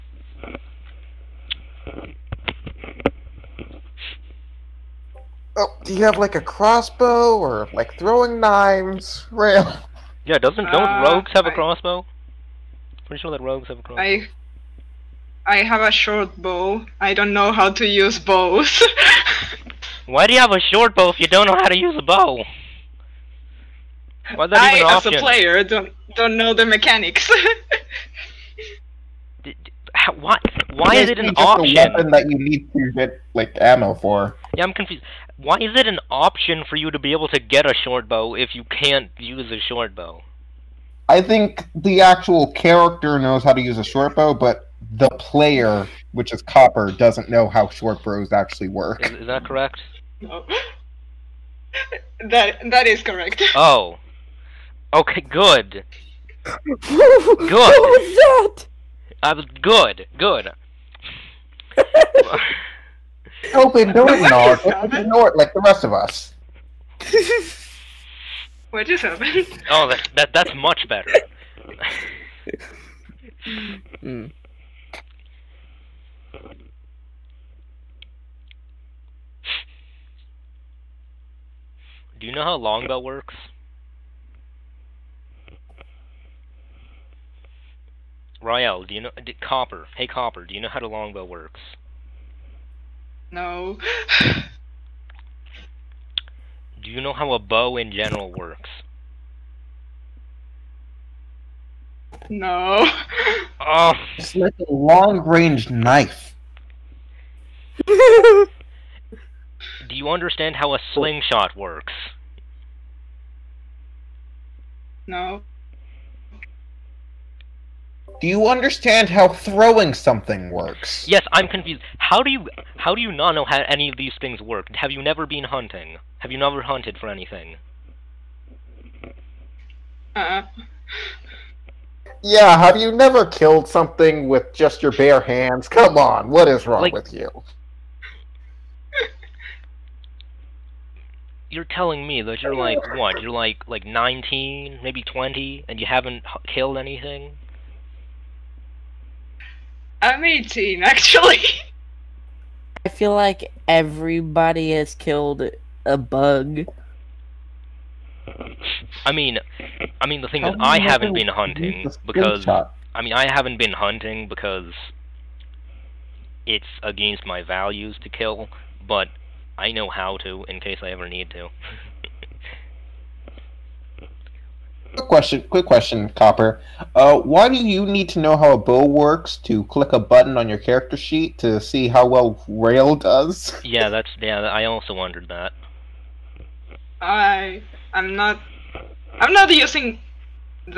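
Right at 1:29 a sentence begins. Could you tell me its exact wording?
Did, Copper, hey Copper, do you know how the longbow works?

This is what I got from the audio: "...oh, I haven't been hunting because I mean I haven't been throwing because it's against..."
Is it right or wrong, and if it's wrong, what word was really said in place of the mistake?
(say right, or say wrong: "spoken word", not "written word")
wrong: "hunting", not "throwing".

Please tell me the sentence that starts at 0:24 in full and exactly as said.
Why is that I, even an as a player, don't don't know the mechanics.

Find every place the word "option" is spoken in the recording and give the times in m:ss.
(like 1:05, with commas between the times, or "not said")
0:31, 0:36.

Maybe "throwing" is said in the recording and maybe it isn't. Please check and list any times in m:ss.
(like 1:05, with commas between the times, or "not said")
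0:07, 1:59.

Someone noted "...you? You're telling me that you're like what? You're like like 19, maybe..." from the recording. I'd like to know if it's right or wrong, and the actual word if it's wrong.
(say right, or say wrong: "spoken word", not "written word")
right.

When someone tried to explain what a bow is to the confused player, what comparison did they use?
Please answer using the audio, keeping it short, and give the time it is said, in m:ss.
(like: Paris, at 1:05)
A long range knife, at 1:44.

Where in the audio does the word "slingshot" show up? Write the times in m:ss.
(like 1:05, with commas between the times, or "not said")
1:50.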